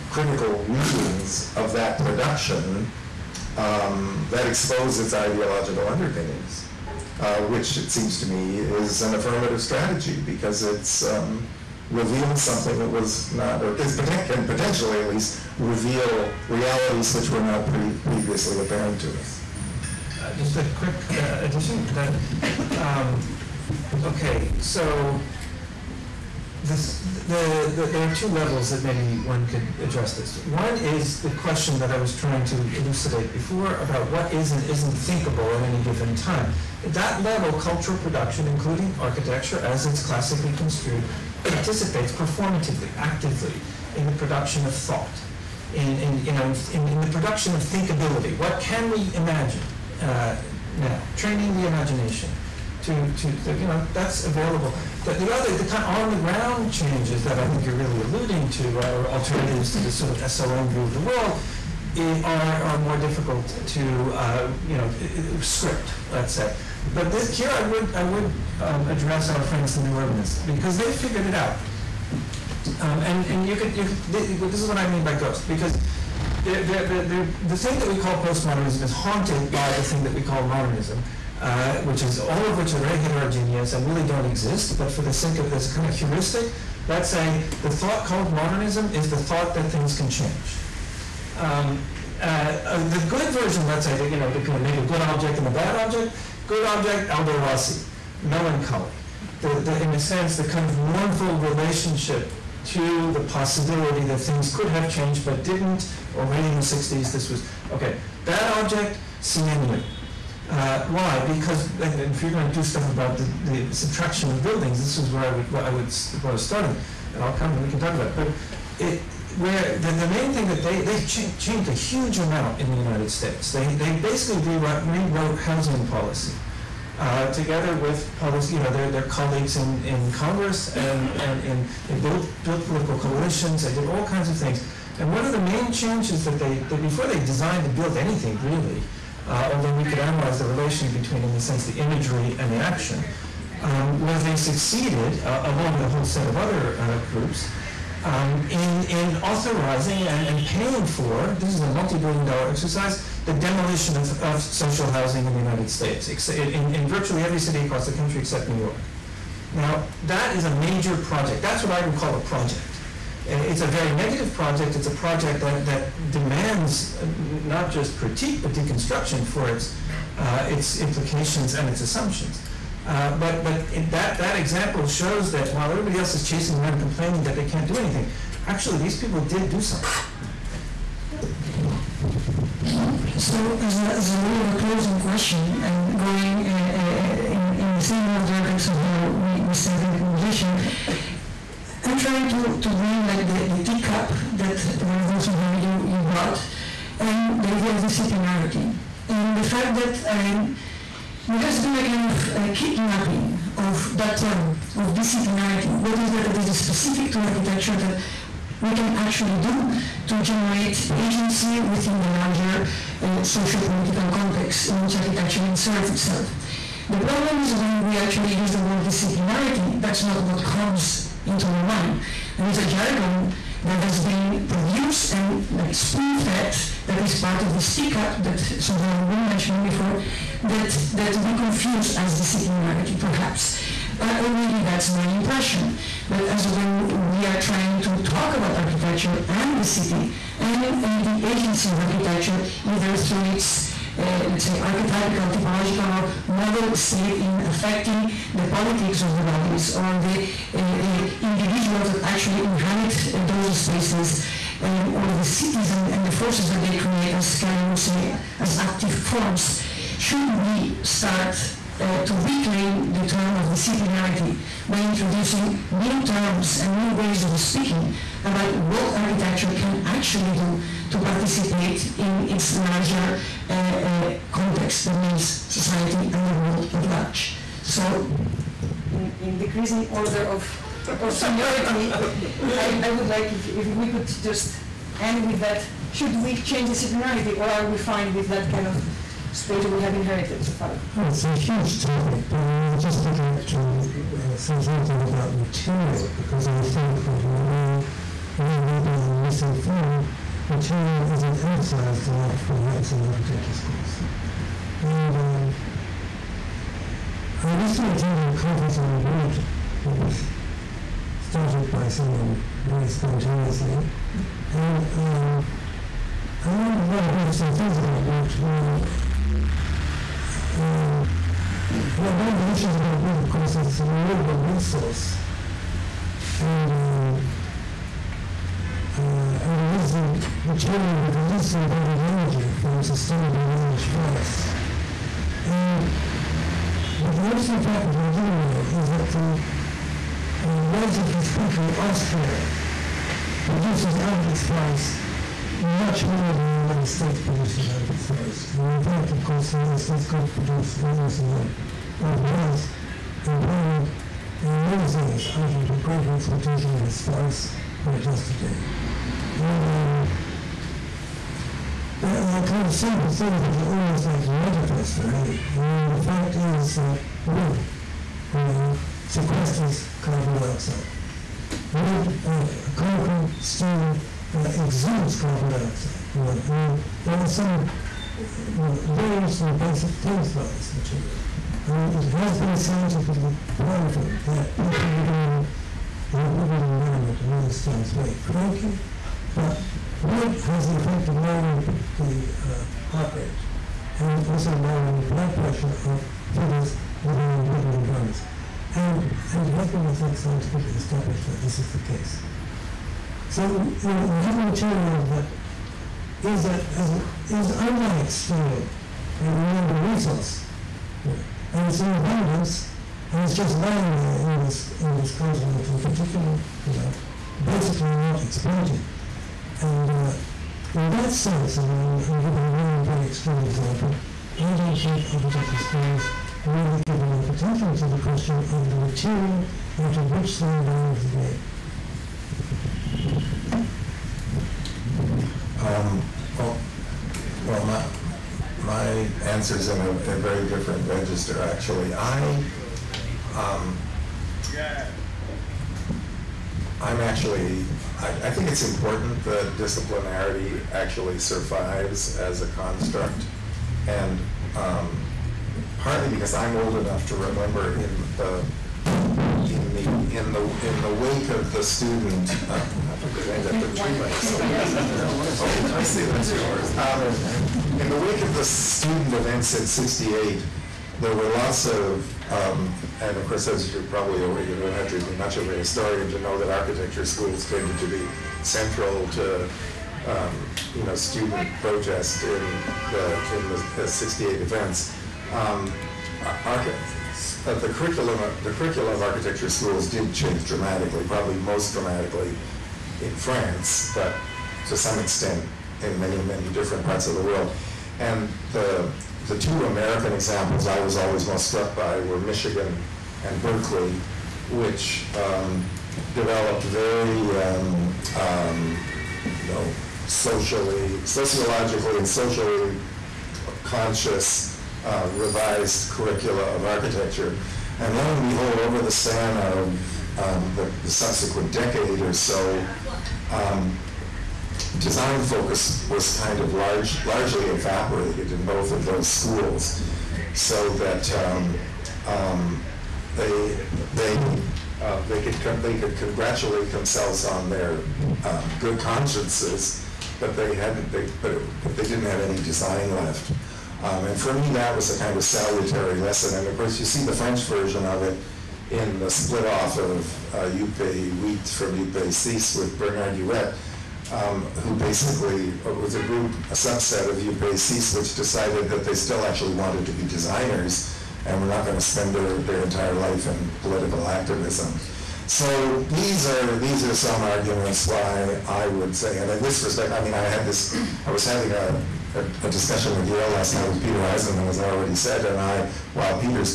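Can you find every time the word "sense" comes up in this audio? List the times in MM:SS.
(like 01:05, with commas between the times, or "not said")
01:39, 02:21, 07:01.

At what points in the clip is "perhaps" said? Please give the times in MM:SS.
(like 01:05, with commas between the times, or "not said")
03:52, 05:02.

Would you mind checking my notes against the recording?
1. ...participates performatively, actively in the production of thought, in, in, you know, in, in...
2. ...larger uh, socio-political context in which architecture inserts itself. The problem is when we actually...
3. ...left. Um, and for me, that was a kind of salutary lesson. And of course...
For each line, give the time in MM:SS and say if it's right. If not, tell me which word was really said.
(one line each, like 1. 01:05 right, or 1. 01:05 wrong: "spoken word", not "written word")
1. 00:41 right
2. 03:32 right
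3. 09:02 right.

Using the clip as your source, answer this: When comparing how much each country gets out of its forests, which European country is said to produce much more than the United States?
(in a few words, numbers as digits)
Austria.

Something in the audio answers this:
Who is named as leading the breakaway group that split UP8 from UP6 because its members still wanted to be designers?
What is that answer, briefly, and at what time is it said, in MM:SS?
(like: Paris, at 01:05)
Bernard Huet, at 09:12.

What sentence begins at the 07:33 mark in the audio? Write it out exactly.
And um, partly because I'm old enough to remember in the in the in the in the wake of the student.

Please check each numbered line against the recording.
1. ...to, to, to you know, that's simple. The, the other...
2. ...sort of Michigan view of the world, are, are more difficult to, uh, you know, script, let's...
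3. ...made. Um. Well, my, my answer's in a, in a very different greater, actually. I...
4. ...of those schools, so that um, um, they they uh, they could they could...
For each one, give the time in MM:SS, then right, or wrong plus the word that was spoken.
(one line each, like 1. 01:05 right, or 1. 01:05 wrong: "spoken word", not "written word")
1. 00:52 wrong: "available", not "simple"
2. 00:59 wrong: "SLM", not "Michigan"
3. 07:13 wrong: "register", not "greater"
4. 08:48 right.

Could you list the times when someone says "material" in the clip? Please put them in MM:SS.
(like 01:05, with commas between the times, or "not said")
04:55, 05:00, 05:30, 06:20, 06:44, 07:08.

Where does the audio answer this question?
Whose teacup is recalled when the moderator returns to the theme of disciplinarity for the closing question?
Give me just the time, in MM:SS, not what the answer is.
03:14.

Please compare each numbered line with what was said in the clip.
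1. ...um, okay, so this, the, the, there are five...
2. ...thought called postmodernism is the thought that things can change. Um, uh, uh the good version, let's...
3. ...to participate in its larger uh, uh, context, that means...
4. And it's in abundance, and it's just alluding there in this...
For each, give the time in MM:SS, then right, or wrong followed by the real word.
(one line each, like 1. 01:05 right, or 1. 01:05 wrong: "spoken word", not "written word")
1. 00:22 wrong: "two", not "five"
2. 01:27 wrong: "modernism", not "postmodernism"
3. 04:30 right
4. 06:51 wrong: "lying", not "alluding".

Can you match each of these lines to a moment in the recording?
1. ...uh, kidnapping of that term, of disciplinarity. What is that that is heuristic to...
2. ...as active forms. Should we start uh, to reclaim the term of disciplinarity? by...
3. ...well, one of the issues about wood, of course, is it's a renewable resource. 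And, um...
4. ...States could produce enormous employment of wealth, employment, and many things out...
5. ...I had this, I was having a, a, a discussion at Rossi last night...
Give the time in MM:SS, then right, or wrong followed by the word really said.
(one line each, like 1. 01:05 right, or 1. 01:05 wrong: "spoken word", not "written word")
1. 03:22 wrong: "specific", not "heuristic"
2. 04:18 right
3. 05:21 right
4. 05:49 wrong: "amount", not "employment"
5. 09:30 wrong: "Yale", not "Rossi".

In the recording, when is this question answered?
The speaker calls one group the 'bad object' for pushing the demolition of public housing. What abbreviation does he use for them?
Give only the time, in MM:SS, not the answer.
01:49.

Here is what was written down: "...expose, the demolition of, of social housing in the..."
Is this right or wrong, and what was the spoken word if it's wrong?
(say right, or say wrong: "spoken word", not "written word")
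wrong: "exercise", not "expose".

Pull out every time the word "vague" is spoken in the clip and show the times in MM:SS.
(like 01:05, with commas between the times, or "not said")
not said.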